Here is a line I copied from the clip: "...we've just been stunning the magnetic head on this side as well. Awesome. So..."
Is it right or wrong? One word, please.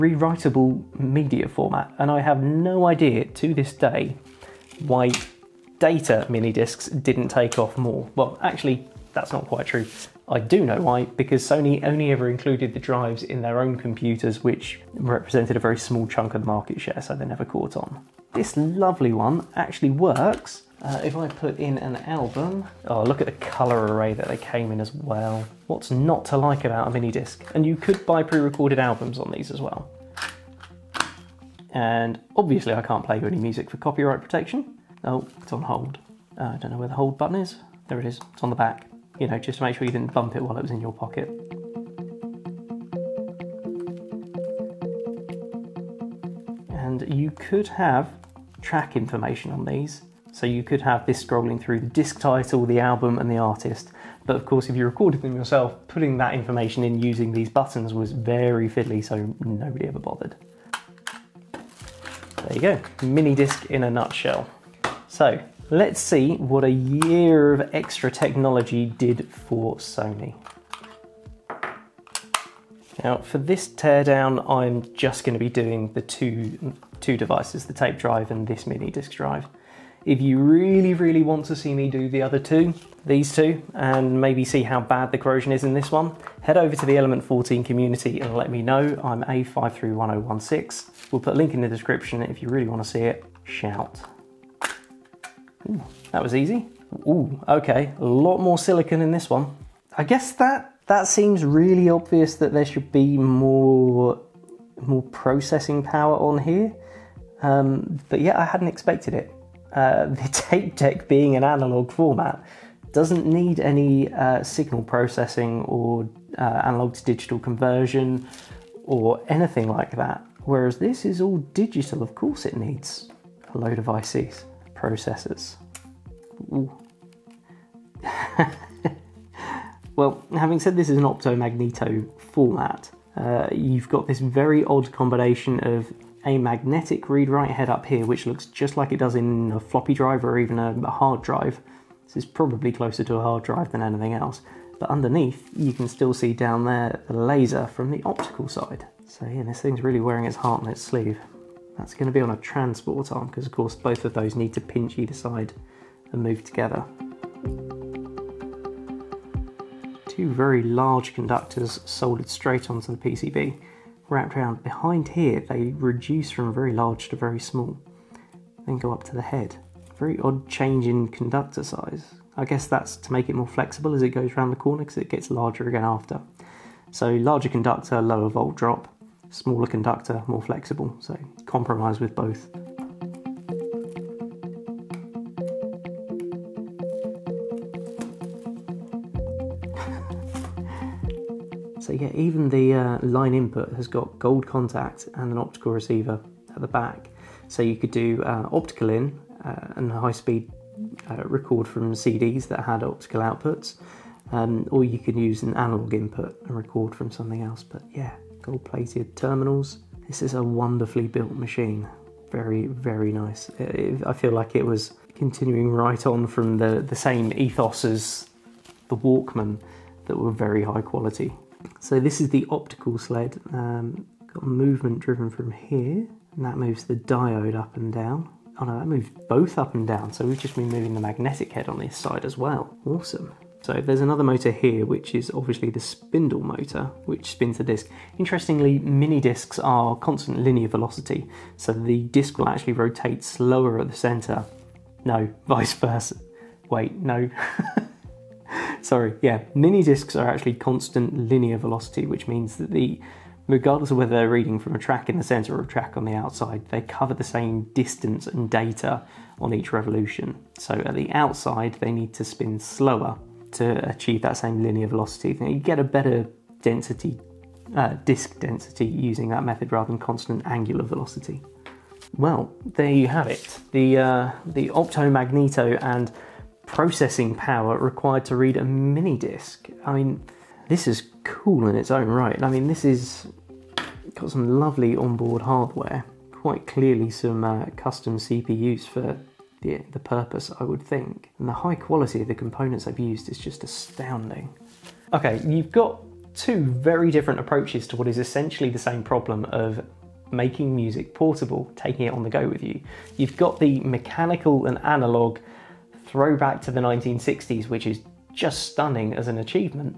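wrong.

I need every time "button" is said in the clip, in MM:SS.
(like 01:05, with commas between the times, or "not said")
00:37, 00:57.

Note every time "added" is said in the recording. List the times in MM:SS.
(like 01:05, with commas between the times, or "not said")
not said.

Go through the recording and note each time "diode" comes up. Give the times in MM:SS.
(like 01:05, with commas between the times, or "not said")
03:46.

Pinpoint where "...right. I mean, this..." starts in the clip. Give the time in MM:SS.
04:42.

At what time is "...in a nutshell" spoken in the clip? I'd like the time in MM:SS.
01:03.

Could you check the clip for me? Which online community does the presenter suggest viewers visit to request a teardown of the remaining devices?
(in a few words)
Element 14.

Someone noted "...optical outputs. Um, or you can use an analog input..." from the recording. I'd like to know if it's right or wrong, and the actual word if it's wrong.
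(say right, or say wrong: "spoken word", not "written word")
right.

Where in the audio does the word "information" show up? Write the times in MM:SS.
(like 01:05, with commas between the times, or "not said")
00:48, 00:56.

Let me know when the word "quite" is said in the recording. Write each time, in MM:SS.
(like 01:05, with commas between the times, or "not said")
00:09, 04:46.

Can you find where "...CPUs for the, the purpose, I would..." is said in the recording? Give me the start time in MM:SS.
04:48.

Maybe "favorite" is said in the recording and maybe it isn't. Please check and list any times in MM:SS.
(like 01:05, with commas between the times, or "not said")
not said.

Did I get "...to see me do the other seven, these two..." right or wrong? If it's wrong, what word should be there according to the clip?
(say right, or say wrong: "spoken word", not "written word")
wrong: "two", not "seven".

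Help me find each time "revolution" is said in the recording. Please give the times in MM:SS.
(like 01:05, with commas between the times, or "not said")
04:19.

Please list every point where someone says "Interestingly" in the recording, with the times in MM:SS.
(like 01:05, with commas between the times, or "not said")
03:58.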